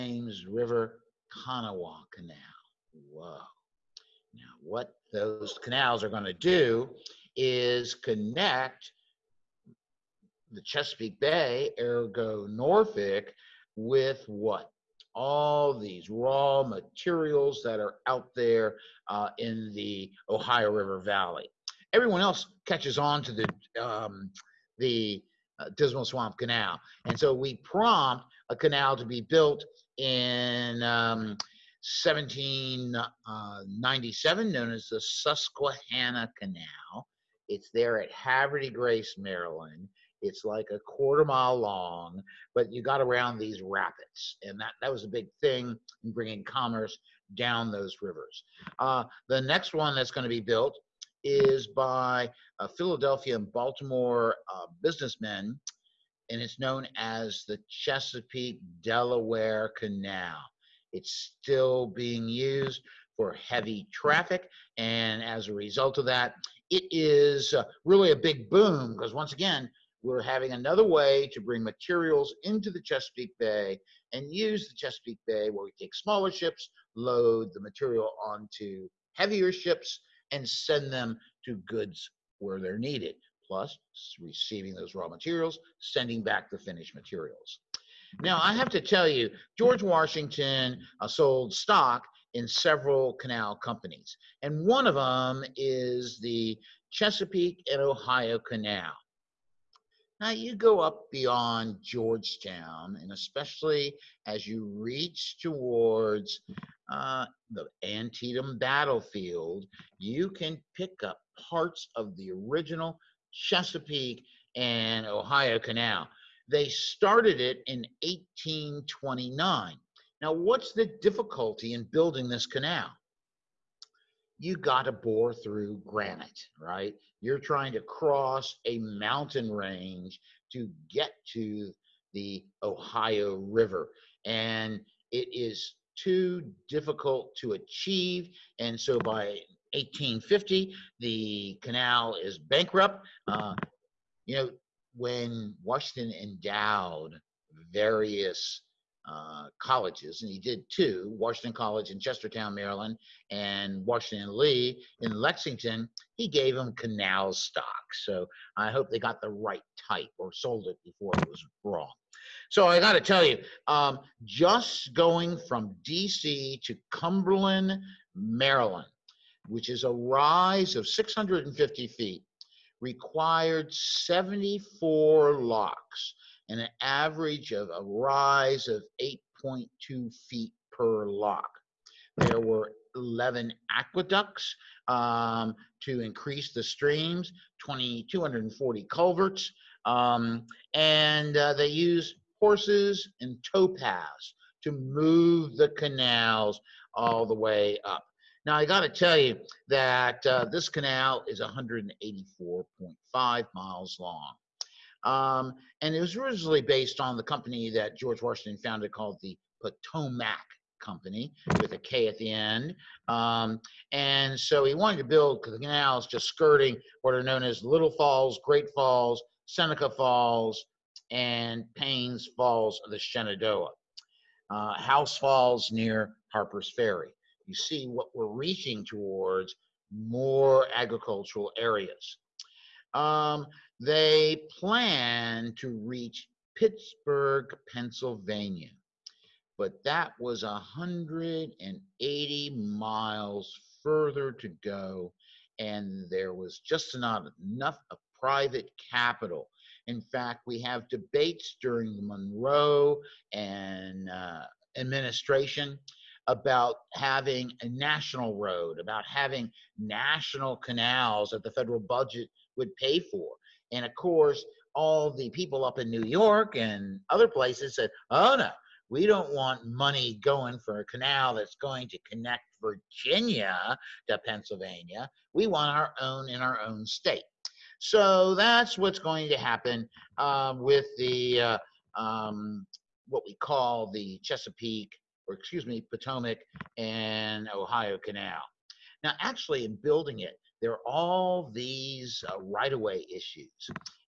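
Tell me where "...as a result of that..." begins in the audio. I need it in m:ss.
1:05.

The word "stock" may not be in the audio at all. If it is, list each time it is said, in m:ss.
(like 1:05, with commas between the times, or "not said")
1:31, 2:37.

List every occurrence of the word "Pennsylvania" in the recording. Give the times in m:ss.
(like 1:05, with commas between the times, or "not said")
3:57, 4:34.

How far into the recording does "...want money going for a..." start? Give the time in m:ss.
4:29.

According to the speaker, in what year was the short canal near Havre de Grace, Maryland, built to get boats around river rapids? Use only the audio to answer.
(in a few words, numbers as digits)
1797.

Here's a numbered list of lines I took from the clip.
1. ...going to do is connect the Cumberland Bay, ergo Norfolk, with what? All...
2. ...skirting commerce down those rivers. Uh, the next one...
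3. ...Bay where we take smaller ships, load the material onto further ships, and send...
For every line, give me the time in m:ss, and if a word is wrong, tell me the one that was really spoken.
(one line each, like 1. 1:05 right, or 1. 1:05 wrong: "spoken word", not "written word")
1. 0:06 wrong: "Chesapeake", not "Cumberland"
2. 0:46 wrong: "bringing", not "skirting"
3. 1:15 wrong: "heavier", not "further".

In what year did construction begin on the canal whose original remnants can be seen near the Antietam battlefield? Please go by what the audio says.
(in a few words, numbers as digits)
1829.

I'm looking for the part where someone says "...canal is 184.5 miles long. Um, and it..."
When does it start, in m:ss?
3:20.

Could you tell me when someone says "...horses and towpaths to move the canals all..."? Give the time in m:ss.
3:12.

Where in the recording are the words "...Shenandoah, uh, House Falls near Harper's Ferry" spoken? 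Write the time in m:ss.
3:42.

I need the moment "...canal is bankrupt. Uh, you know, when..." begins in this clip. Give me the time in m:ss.
2:21.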